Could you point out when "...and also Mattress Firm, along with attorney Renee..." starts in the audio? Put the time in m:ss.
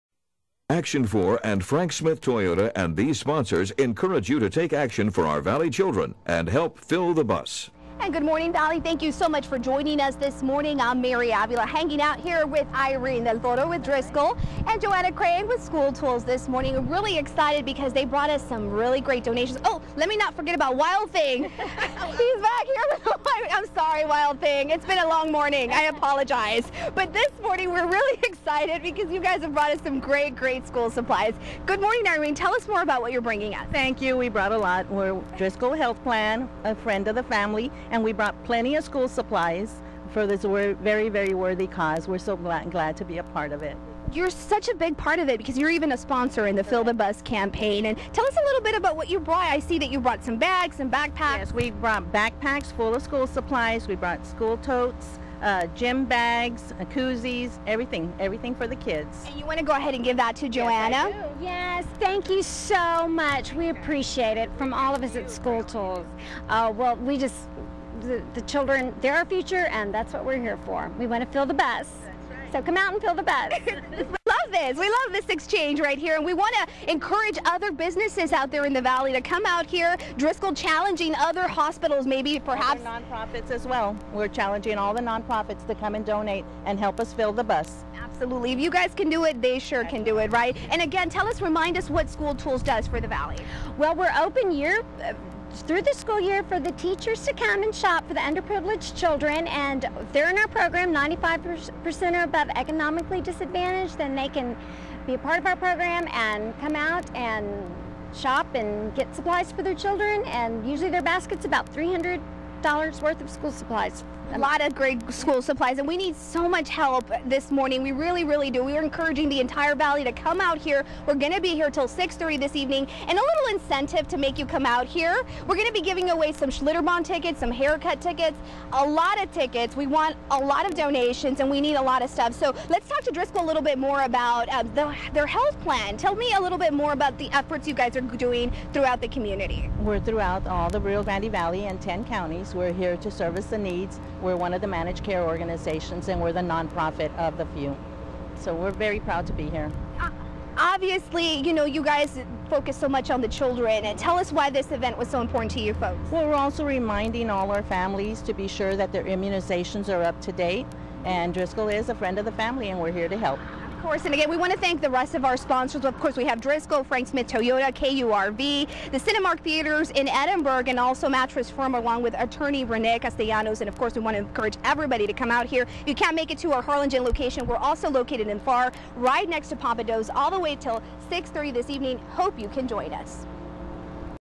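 2:50.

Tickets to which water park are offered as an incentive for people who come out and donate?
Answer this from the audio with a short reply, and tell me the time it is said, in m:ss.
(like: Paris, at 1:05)
Schlitterbahn, at 2:06.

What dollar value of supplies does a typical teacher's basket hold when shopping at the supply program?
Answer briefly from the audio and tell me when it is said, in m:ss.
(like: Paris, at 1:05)
$300, at 1:51.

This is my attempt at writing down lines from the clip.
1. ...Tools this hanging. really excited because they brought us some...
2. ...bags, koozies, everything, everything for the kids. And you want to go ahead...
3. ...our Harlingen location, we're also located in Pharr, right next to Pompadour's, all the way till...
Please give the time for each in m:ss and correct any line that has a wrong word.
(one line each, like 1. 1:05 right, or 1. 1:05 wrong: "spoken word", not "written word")
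1. 0:15 wrong: "morning", not "hanging"
2. 0:56 right
3. 2:56 right.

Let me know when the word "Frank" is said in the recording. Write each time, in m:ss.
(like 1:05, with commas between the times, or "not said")
0:01, 2:46.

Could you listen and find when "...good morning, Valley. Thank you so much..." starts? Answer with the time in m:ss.
0:08.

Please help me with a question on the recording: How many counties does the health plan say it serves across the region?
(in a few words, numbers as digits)
10.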